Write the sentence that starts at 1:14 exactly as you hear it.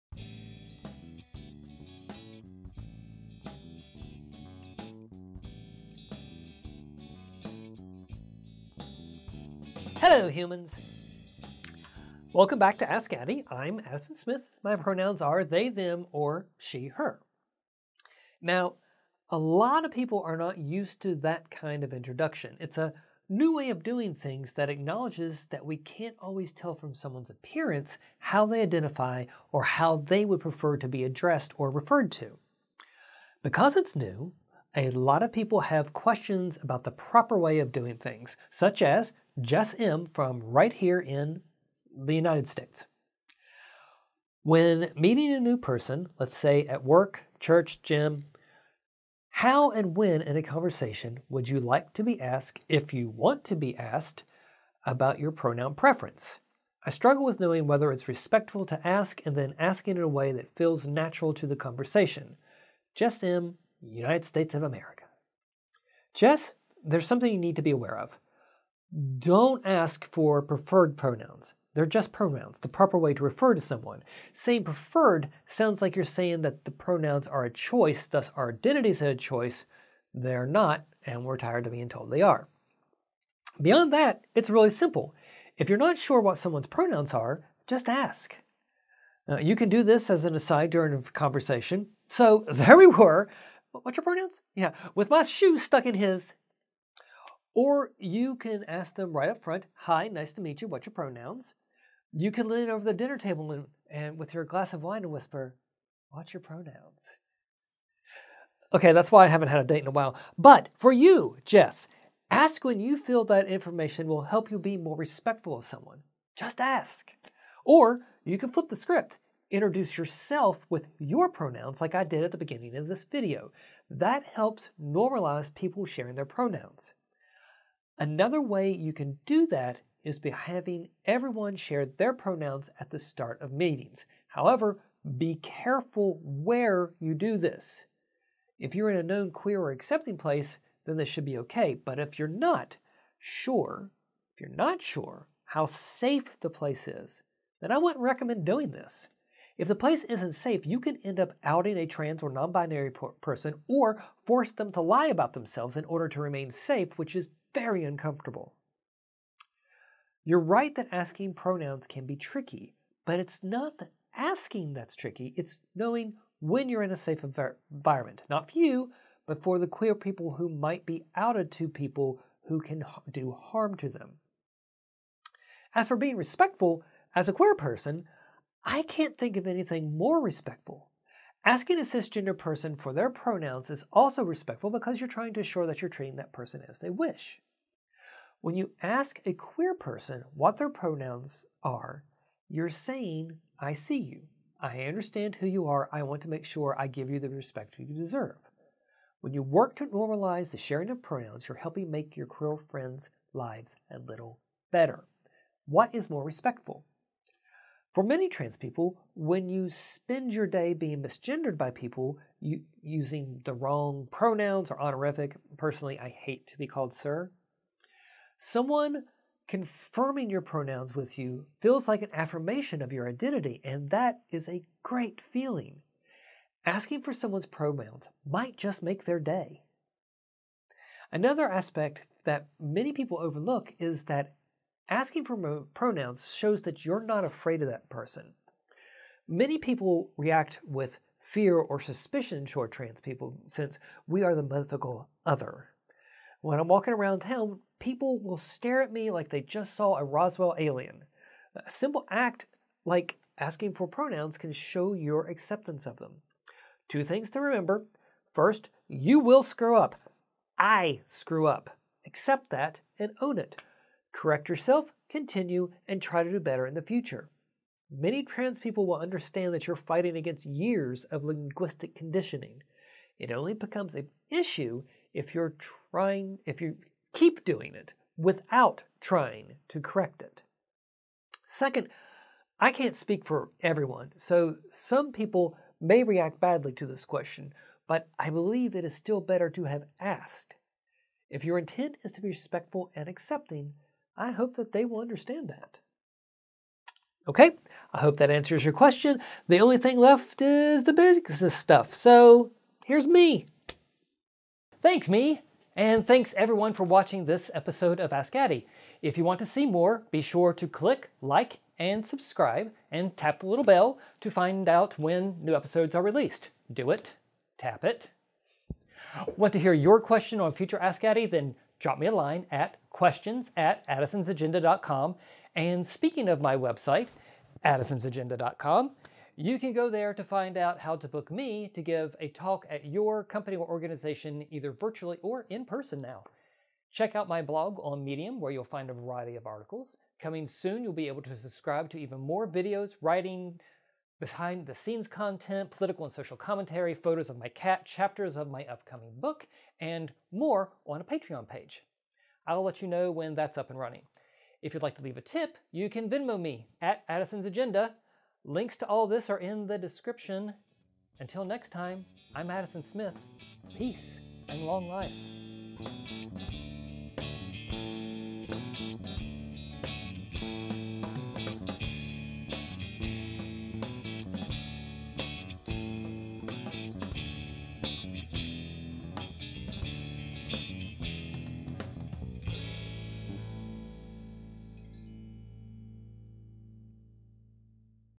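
Saying preferred sounds like you're saying that the pronouns are a choice, thus our identities are a choice.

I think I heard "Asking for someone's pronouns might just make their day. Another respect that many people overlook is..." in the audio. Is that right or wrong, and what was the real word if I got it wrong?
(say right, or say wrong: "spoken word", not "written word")
wrong: "aspect", not "respect".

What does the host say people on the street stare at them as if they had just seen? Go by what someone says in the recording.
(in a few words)
a Roswell alien.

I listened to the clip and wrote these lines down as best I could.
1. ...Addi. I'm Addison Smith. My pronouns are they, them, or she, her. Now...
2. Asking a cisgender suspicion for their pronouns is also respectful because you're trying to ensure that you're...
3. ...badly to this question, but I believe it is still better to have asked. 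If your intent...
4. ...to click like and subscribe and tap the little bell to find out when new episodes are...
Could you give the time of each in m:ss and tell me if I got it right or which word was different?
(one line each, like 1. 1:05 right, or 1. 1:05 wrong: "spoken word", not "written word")
1. 0:13 right
2. 3:01 wrong: "person", not "suspicion"
3. 4:46 right
4. 5:10 right.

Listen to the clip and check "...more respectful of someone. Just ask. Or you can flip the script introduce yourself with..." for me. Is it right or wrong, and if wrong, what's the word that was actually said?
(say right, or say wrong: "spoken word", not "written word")
right.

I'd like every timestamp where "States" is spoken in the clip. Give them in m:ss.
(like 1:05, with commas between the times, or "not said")
0:42, 1:04.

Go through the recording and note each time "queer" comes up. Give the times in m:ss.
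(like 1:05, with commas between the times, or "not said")
2:19, 2:49, 2:57, 3:09, 3:22.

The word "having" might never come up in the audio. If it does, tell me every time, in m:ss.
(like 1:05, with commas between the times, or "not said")
2:10.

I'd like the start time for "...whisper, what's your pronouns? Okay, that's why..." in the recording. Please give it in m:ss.
1:45.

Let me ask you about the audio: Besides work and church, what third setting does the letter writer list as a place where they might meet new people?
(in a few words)
gym.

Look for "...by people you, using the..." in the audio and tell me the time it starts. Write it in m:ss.
3:31.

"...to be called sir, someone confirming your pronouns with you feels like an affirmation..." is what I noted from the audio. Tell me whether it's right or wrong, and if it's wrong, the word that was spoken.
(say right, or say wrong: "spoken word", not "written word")
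right.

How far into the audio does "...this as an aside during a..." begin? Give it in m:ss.
1:29.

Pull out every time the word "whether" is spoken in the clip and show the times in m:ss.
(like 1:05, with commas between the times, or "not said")
0:57.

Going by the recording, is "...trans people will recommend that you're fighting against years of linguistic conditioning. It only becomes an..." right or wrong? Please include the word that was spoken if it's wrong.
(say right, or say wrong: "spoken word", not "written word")
wrong: "understand", not "recommend".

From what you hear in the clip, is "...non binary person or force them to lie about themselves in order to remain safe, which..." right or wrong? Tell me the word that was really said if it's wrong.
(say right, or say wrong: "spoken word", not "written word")
right.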